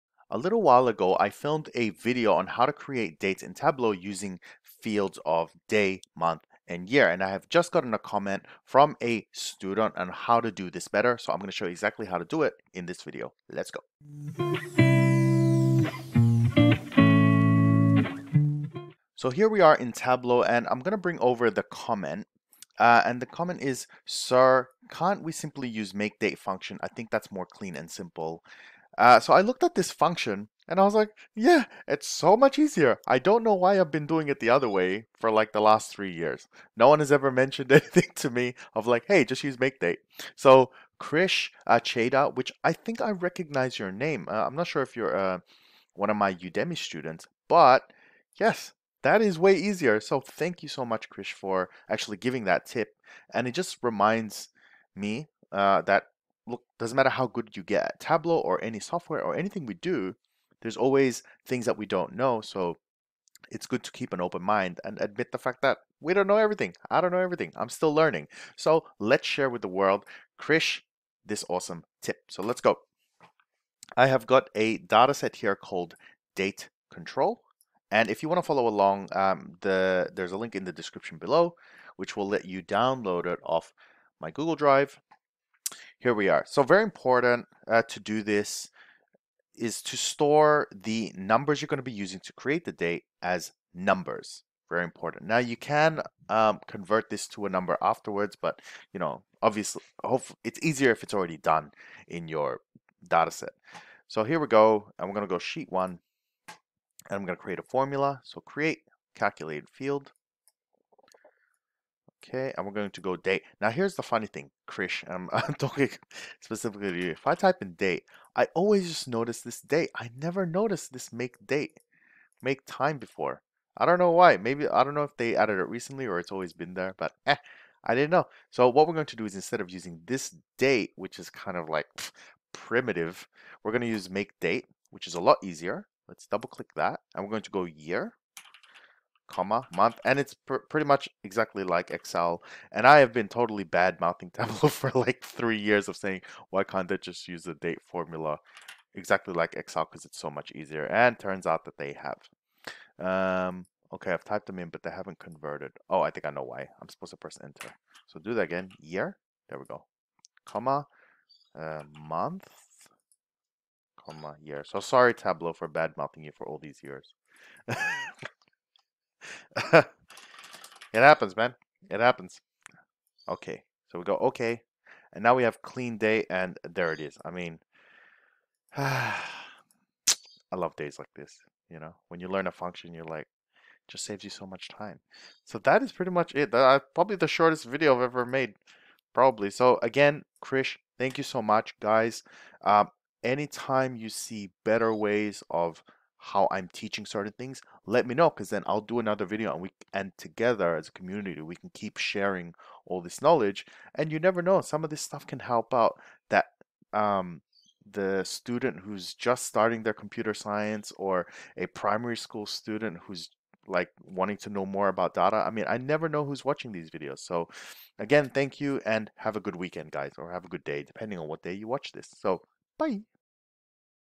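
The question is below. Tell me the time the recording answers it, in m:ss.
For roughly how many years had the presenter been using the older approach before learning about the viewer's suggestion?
0:35.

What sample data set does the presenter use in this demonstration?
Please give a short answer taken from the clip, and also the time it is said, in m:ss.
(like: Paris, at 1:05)
date control, at 1:16.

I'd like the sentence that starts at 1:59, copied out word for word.
I never noticed this make date, make time before.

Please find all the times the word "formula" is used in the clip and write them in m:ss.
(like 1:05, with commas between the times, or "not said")
1:47, 2:27.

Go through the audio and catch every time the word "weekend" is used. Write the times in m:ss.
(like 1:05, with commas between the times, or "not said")
3:39.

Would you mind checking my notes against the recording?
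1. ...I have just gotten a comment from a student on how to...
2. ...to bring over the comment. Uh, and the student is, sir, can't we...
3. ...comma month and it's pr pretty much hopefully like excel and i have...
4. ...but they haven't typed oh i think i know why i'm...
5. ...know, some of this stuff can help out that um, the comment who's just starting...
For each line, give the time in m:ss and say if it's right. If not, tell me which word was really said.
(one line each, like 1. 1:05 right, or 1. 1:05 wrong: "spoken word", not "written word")
1. 0:07 right
2. 0:20 wrong: "comment", not "student"
3. 2:19 wrong: "exactly", not "hopefully"
4. 2:34 wrong: "converted", not "typed"
5. 3:24 wrong: "student", not "comment".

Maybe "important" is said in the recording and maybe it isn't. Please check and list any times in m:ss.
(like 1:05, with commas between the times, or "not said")
1:26, 1:34.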